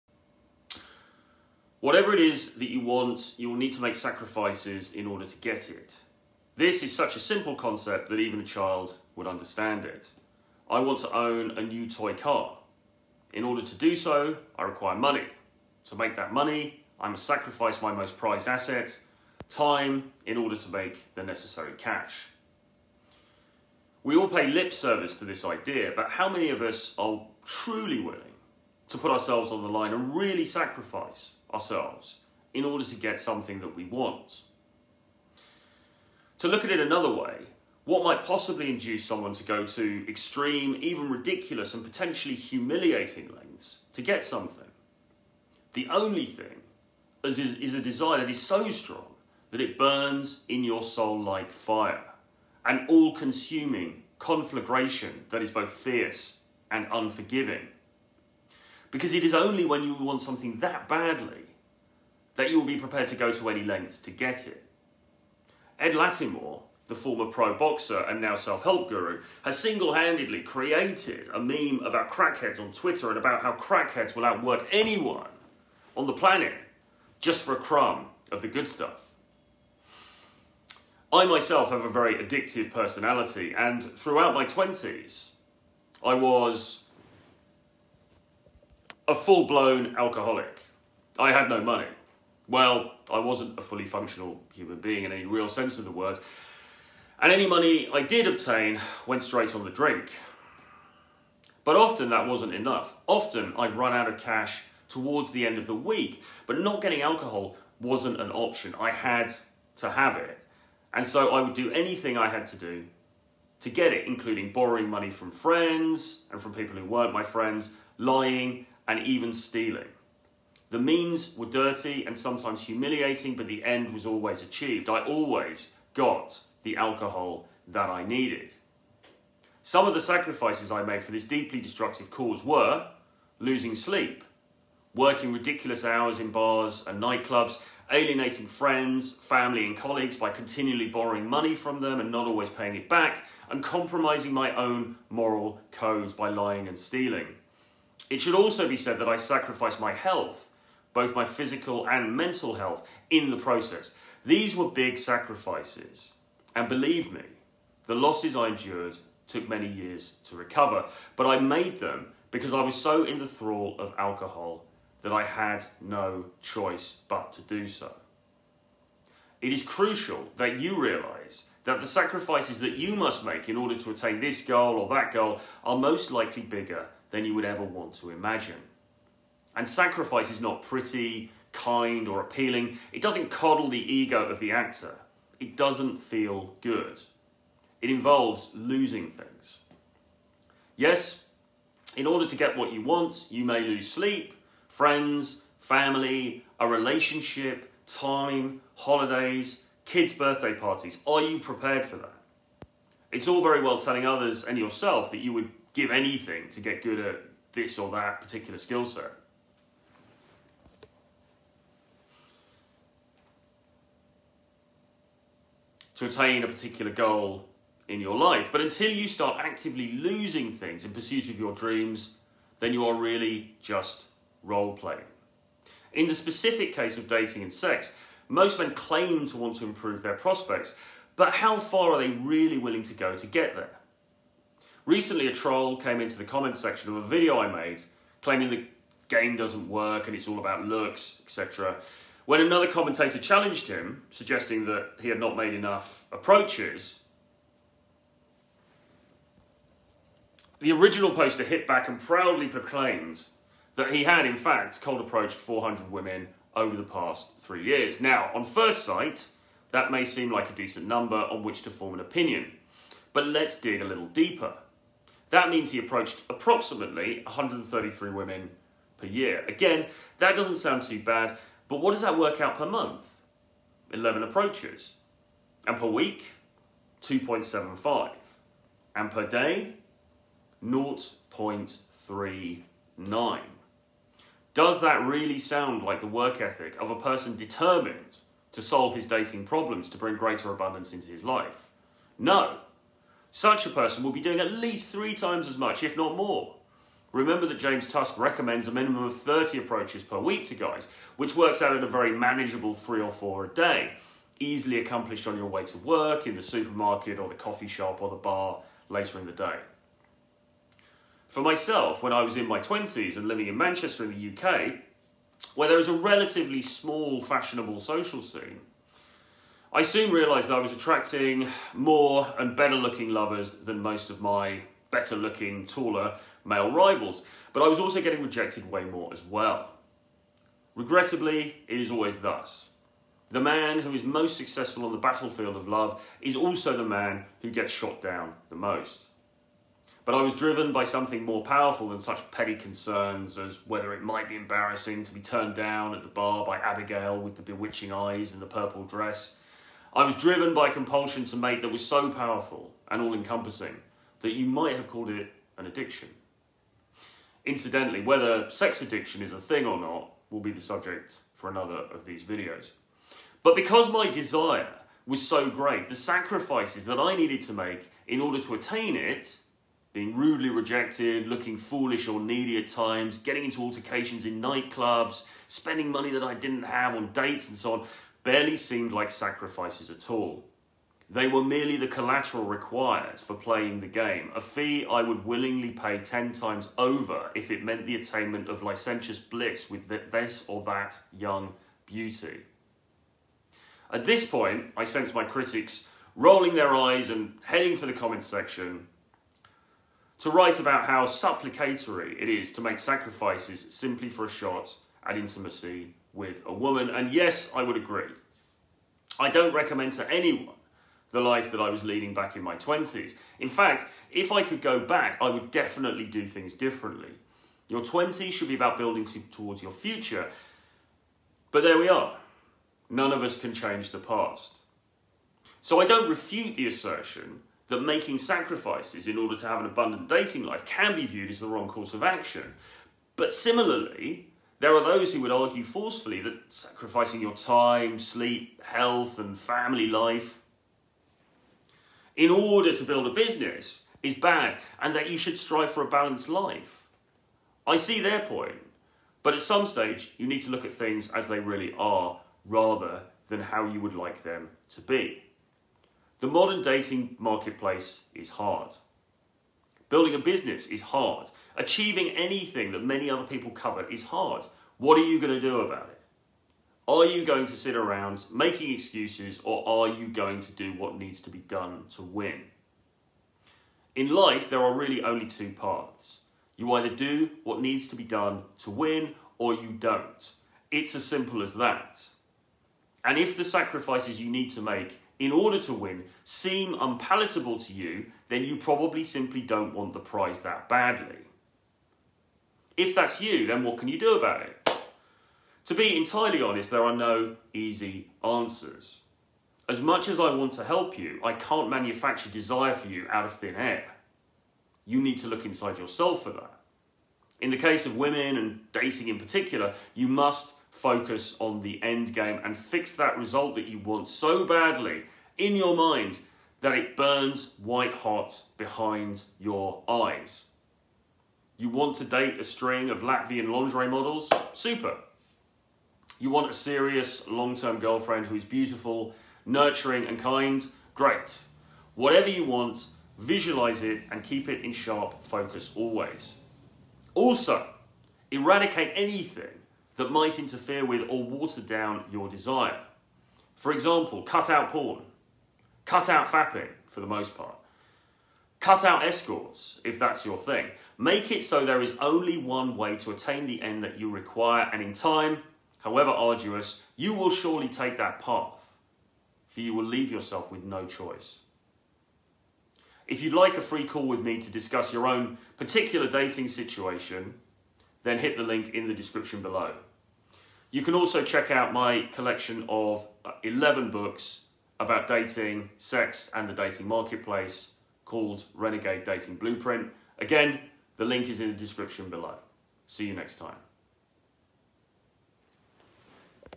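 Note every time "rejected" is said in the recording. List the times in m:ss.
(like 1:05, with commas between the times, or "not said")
5:28, 6:10.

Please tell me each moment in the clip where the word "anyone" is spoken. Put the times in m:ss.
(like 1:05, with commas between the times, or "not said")
1:14, 6:50.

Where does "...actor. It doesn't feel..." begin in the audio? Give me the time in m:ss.
3:04.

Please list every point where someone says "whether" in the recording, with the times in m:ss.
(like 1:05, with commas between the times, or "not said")
5:43, 5:58.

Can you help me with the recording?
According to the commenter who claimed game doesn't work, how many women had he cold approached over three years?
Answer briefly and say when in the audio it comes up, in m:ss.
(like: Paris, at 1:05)
400, at 4:15.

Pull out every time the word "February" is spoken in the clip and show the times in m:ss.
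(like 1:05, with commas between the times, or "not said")
not said.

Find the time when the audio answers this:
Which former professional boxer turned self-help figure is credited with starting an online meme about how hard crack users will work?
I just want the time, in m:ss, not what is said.
1:05.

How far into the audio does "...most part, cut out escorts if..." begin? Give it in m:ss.
9:07.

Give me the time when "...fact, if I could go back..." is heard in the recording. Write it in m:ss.
6:53.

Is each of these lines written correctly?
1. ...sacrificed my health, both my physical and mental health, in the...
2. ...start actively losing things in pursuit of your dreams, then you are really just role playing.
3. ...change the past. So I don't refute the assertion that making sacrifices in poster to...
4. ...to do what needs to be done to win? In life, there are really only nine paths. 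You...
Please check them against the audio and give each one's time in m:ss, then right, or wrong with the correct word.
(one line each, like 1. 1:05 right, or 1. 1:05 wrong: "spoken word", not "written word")
1. 2:29 right
2. 3:39 right
3. 7:03 wrong: "order", not "poster"
4. 7:50 wrong: "two", not "nine".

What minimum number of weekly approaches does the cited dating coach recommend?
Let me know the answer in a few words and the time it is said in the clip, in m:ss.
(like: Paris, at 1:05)
30, at 4:59.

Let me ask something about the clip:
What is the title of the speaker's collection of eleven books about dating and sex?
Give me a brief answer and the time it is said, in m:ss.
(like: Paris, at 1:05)
Renegade Dating Blueprint, at 9:38.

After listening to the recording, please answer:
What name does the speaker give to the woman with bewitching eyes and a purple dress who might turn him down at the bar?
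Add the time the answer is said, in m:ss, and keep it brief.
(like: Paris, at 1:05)
Abigail, at 5:46.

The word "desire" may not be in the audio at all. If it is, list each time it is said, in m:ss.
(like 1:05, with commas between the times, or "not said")
0:47, 6:04, 8:22, 9:02.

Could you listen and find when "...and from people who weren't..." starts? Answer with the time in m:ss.
1:56.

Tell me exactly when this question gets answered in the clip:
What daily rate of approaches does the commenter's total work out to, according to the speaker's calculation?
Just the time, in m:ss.
4:40.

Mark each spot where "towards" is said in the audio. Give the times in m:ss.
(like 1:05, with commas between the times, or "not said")
1:44, 6:59.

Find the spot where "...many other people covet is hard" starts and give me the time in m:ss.
7:42.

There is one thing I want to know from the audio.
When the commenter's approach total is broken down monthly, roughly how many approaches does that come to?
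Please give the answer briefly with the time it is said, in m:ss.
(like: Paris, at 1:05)
11, at 4:33.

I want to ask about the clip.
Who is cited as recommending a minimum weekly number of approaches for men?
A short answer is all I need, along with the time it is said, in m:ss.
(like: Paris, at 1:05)
James Tusk, at 4:57.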